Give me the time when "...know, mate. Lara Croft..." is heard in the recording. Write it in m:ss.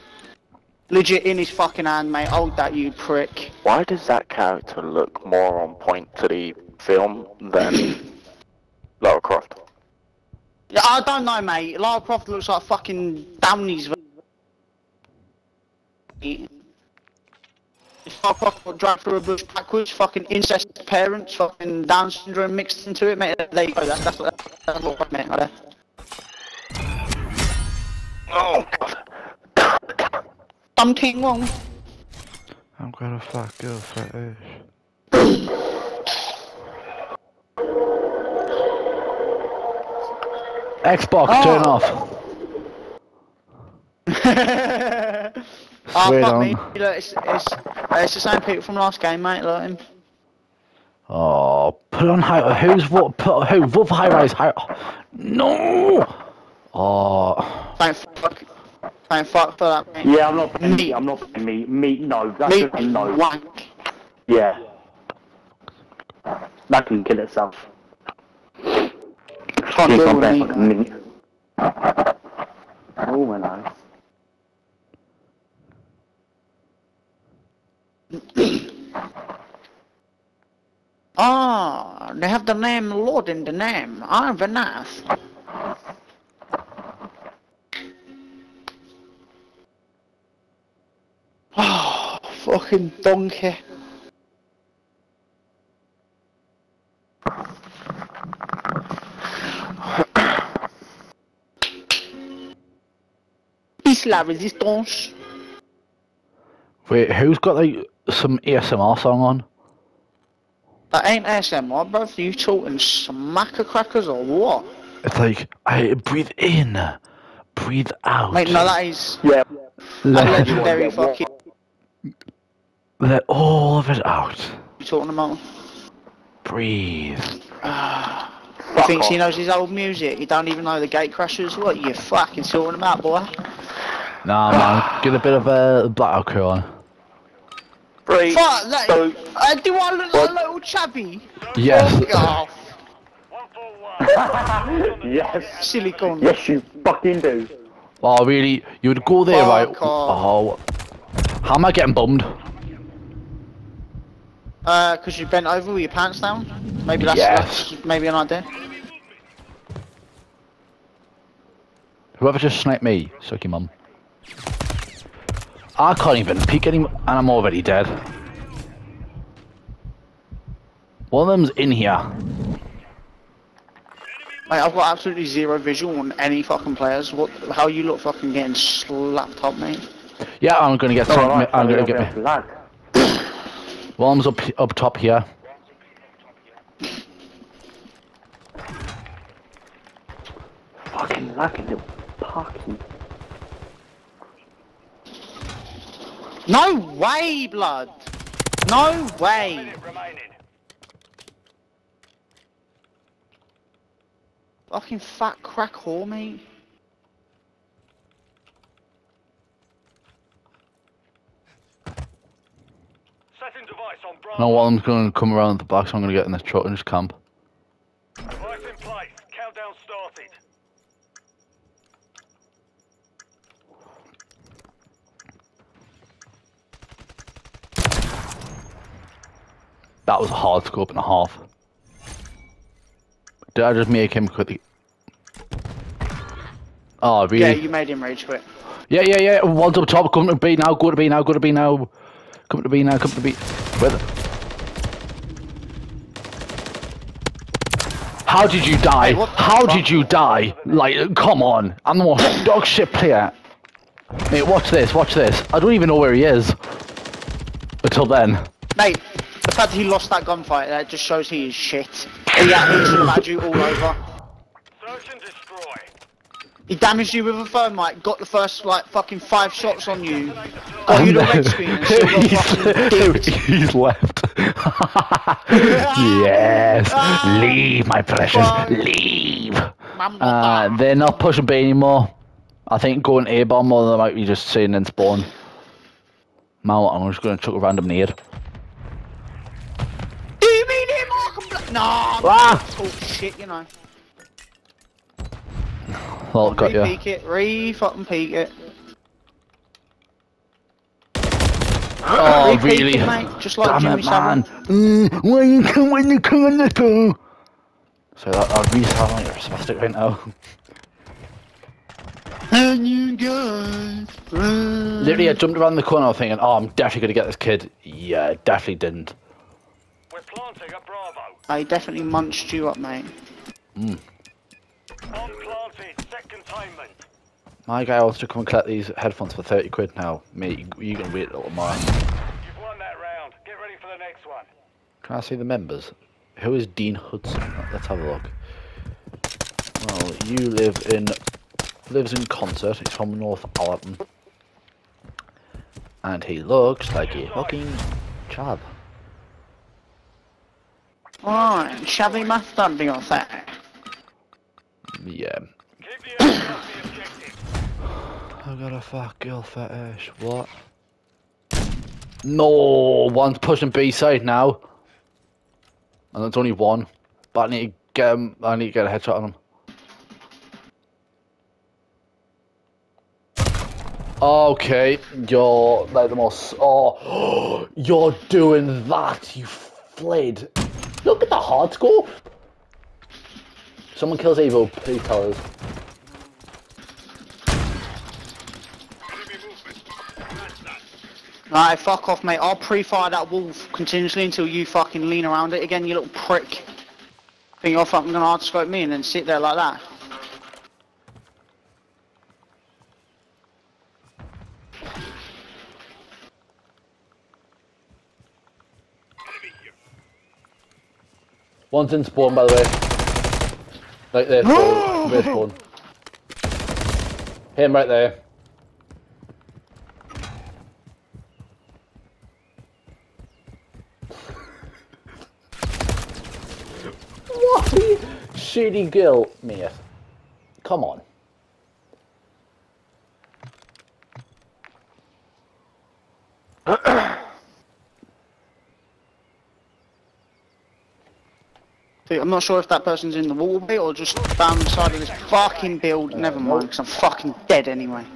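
0:11.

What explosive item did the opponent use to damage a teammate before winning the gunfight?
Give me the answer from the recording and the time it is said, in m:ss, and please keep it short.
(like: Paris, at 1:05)
thermite, at 4:27.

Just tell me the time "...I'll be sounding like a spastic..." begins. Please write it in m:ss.
5:08.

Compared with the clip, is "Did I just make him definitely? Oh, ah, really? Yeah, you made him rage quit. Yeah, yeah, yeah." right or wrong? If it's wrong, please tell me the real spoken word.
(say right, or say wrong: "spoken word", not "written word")
wrong: "quickly", not "definitely".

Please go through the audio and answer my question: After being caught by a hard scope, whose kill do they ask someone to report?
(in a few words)
Evo.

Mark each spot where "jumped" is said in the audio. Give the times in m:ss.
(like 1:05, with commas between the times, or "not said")
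5:15.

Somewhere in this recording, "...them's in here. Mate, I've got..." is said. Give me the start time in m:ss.
2:51.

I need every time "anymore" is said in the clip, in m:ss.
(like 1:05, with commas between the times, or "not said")
2:46, 4:41.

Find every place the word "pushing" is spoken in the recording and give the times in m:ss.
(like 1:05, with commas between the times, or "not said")
4:41, 6:03.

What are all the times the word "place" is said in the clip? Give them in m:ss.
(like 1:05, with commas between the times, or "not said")
3:38.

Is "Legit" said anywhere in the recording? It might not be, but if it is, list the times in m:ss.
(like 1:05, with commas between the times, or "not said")
0:00.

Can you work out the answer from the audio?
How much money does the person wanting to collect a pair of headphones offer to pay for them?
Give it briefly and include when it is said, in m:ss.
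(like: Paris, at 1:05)
£30, at 5:29.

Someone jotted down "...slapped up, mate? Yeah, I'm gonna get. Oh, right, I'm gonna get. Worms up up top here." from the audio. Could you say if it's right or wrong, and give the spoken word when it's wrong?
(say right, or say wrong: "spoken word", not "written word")
right.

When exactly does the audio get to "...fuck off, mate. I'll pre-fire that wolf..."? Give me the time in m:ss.
6:31.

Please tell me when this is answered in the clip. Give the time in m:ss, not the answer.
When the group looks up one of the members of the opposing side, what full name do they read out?
5:36.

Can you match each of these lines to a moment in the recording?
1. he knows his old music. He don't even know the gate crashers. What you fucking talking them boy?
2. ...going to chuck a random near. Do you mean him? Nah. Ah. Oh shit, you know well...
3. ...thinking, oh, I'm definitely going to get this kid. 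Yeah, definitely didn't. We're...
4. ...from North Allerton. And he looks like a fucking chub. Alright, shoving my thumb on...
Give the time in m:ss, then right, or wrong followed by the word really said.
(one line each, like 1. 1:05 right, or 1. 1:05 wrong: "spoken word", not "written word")
1. 2:09 right
2. 4:47 right
3. 5:16 right
4. 5:42 right.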